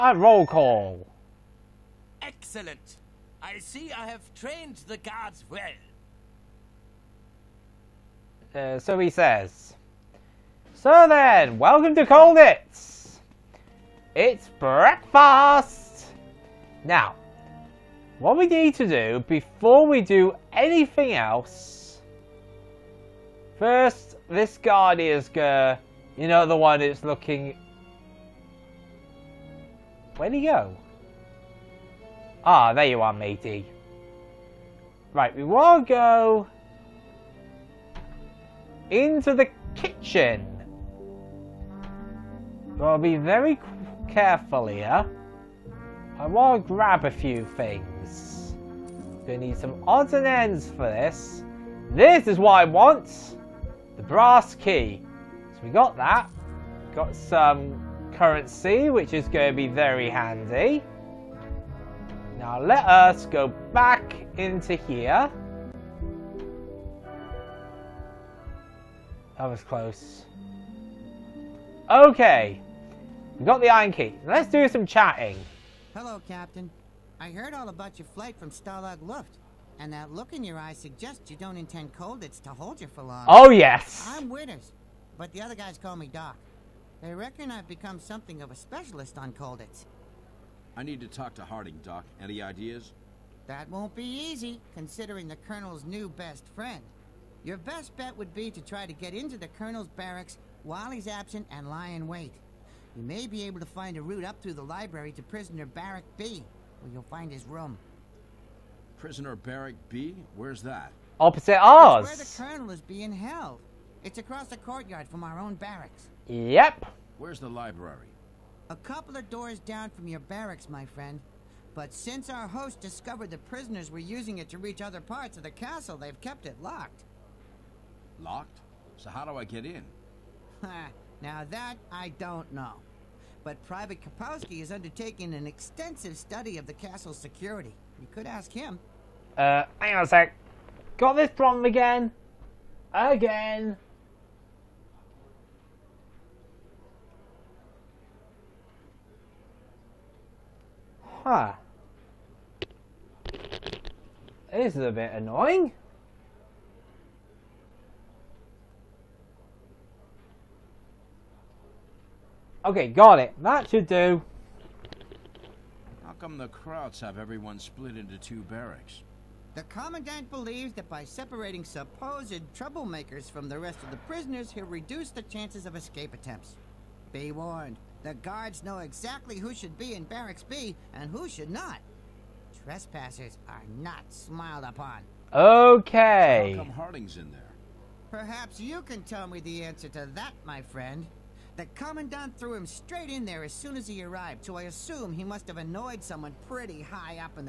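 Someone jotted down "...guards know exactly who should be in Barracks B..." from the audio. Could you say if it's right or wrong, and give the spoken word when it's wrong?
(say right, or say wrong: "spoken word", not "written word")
right.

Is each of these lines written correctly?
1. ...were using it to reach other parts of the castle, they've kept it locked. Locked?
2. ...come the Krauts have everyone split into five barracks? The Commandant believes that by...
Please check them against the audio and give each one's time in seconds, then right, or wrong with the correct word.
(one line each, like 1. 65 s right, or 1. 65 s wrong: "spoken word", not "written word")
1. 123 s right
2. 166 s wrong: "two", not "five".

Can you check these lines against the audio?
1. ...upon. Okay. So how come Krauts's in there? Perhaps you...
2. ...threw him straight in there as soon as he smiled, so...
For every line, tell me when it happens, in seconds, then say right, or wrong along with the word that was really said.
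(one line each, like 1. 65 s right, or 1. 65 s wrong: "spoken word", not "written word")
1. 184 s wrong: "Harding", not "Krauts"
2. 192 s wrong: "arrived", not "smiled".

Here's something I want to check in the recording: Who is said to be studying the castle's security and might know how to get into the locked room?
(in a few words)
Private Kapowski.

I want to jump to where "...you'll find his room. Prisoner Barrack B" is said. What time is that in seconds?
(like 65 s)
106 s.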